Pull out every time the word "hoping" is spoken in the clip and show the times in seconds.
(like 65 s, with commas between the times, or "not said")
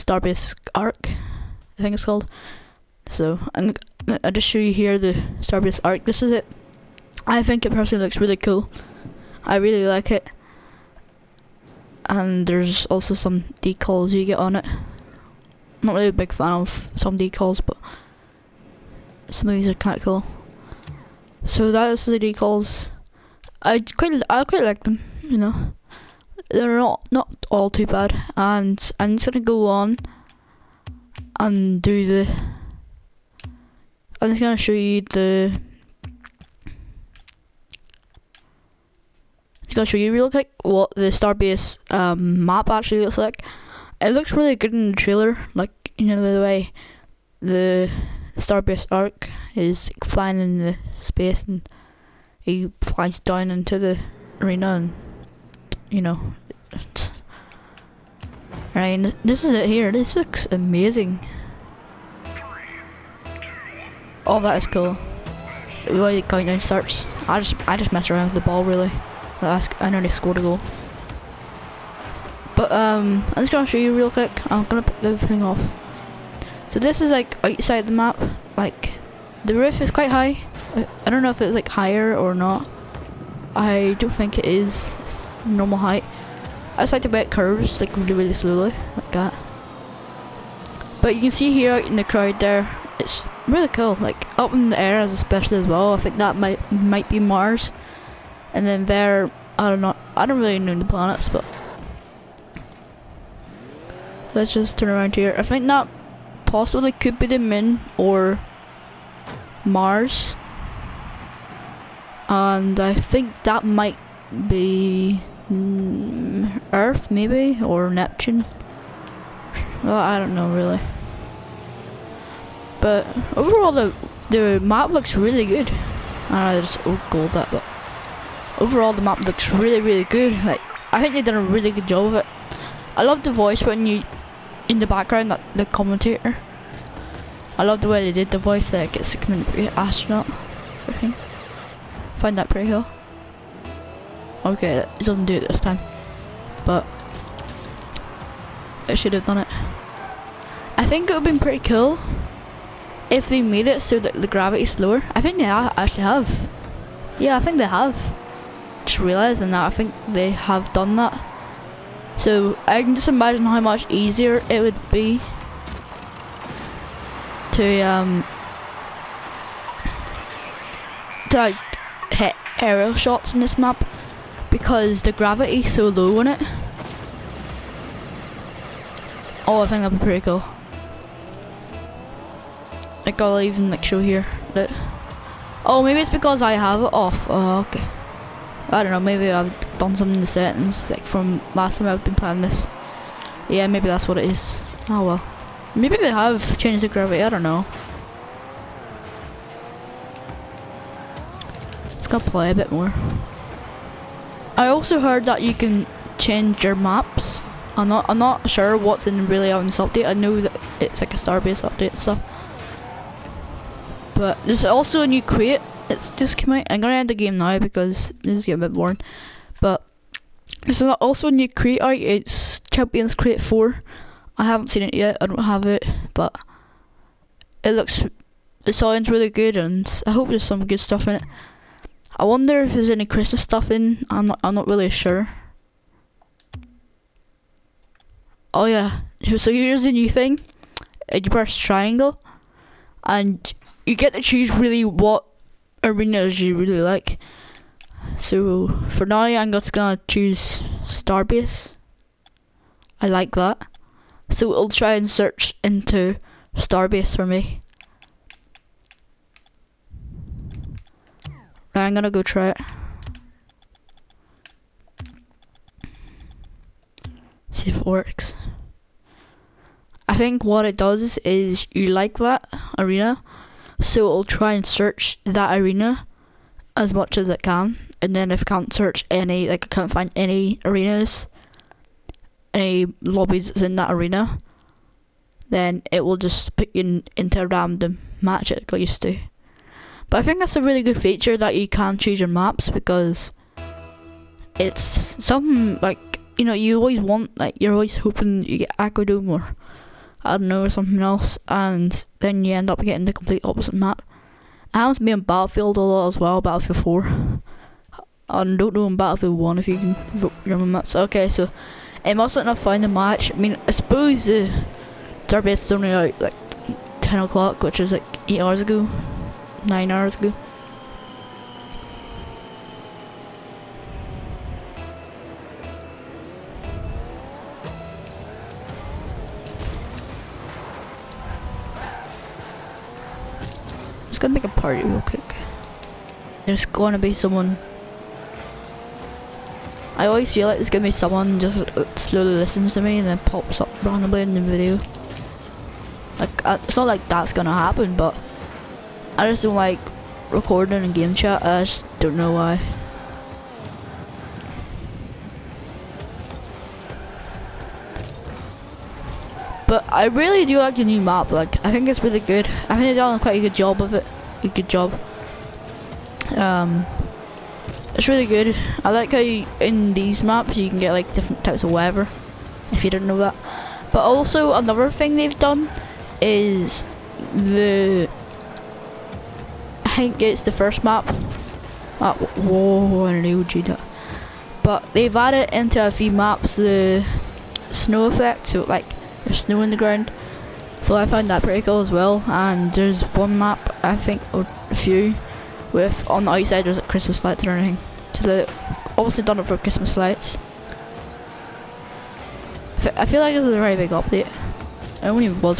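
297 s.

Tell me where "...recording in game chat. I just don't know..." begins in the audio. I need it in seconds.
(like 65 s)
350 s.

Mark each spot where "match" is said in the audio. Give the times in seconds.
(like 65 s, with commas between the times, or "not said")
288 s, 312 s.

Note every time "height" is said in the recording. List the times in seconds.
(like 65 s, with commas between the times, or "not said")
85 s.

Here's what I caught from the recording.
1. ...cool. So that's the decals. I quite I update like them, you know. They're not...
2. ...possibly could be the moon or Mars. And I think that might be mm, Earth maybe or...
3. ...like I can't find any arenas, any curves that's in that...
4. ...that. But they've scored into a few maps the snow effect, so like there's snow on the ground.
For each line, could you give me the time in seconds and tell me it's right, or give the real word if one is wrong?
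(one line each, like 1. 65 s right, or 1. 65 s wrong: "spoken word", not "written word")
1. 20 s wrong: "quite", not "update"
2. 106 s right
3. 279 s wrong: "lobbies", not "curves"
4. 383 s wrong: "added", not "scored".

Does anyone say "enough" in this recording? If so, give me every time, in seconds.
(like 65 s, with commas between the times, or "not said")
312 s.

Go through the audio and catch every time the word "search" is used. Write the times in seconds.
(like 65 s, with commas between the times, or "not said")
255 s, 274 s, 278 s.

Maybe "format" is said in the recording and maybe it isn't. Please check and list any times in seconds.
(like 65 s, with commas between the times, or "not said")
not said.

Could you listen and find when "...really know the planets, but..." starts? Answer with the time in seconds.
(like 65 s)
100 s.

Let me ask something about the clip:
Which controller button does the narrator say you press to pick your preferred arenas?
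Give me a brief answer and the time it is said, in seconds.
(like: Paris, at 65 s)
Triangle, at 241 s.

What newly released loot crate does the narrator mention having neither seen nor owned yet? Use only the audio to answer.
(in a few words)
Champions Crate 4.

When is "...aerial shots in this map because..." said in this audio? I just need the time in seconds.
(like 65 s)
172 s.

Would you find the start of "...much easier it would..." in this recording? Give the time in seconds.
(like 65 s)
163 s.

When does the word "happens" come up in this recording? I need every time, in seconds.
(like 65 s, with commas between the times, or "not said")
304 s, 347 s.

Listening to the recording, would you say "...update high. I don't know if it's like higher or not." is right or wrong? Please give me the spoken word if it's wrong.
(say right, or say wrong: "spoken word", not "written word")
wrong: "quite", not "update".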